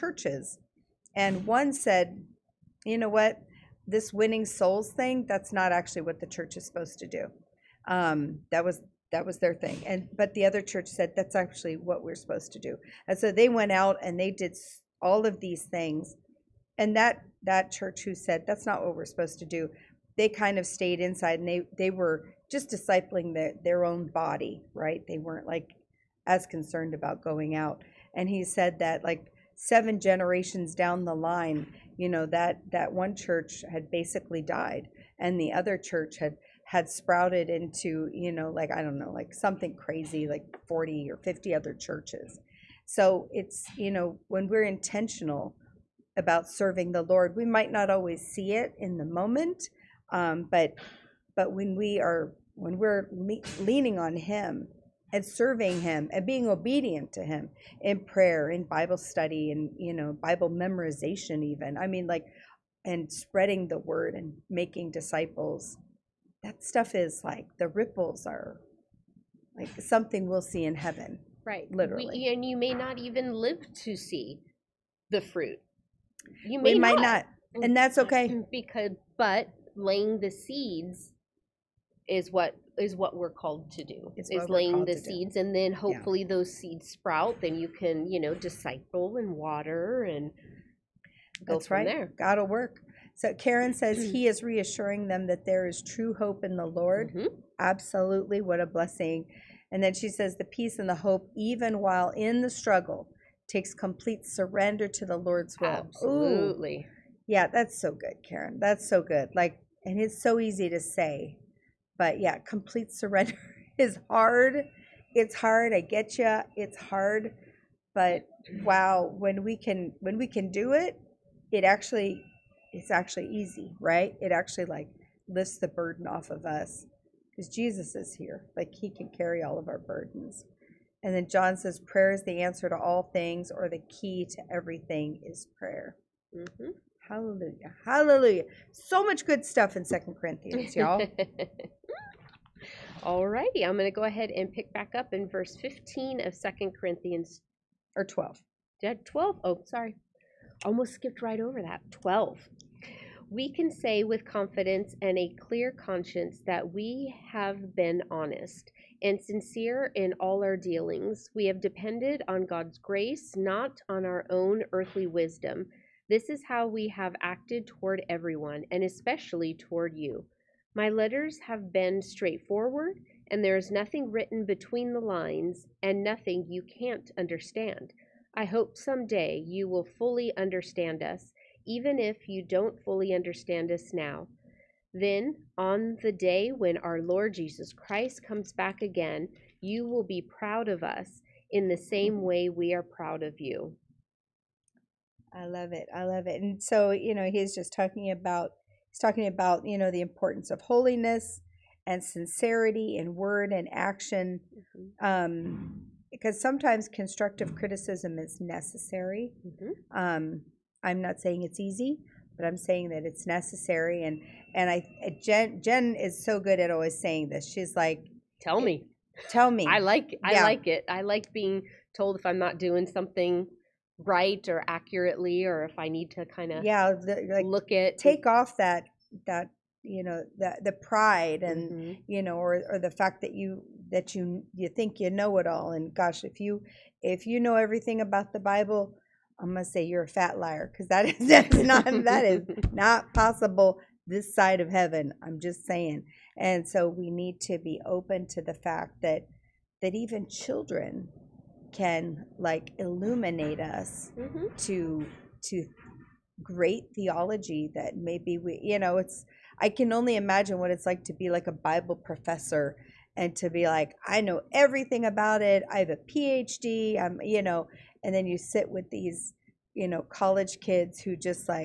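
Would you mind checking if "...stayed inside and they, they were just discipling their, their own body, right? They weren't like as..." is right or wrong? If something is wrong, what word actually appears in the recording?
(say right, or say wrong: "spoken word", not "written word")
right.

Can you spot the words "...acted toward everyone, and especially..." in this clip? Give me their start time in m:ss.
2:47.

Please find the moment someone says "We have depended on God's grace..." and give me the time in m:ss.
2:41.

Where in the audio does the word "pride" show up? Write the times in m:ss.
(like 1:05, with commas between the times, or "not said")
3:50.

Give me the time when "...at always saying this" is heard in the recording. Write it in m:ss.
3:36.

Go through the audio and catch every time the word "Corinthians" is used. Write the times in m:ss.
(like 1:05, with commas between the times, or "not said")
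2:20, 2:26.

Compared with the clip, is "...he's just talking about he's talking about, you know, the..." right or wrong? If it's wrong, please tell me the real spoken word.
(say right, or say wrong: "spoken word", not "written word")
right.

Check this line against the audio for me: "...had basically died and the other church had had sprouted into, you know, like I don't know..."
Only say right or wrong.
right.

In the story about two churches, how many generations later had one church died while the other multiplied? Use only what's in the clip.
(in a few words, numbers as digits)
7.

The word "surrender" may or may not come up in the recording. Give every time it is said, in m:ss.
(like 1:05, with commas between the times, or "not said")
1:44, 1:52.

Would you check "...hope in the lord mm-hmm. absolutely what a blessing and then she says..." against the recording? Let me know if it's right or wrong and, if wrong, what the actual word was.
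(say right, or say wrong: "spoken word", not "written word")
right.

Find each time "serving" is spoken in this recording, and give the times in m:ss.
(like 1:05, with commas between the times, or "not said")
0:46, 0:55.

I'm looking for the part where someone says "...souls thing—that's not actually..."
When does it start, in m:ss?
0:04.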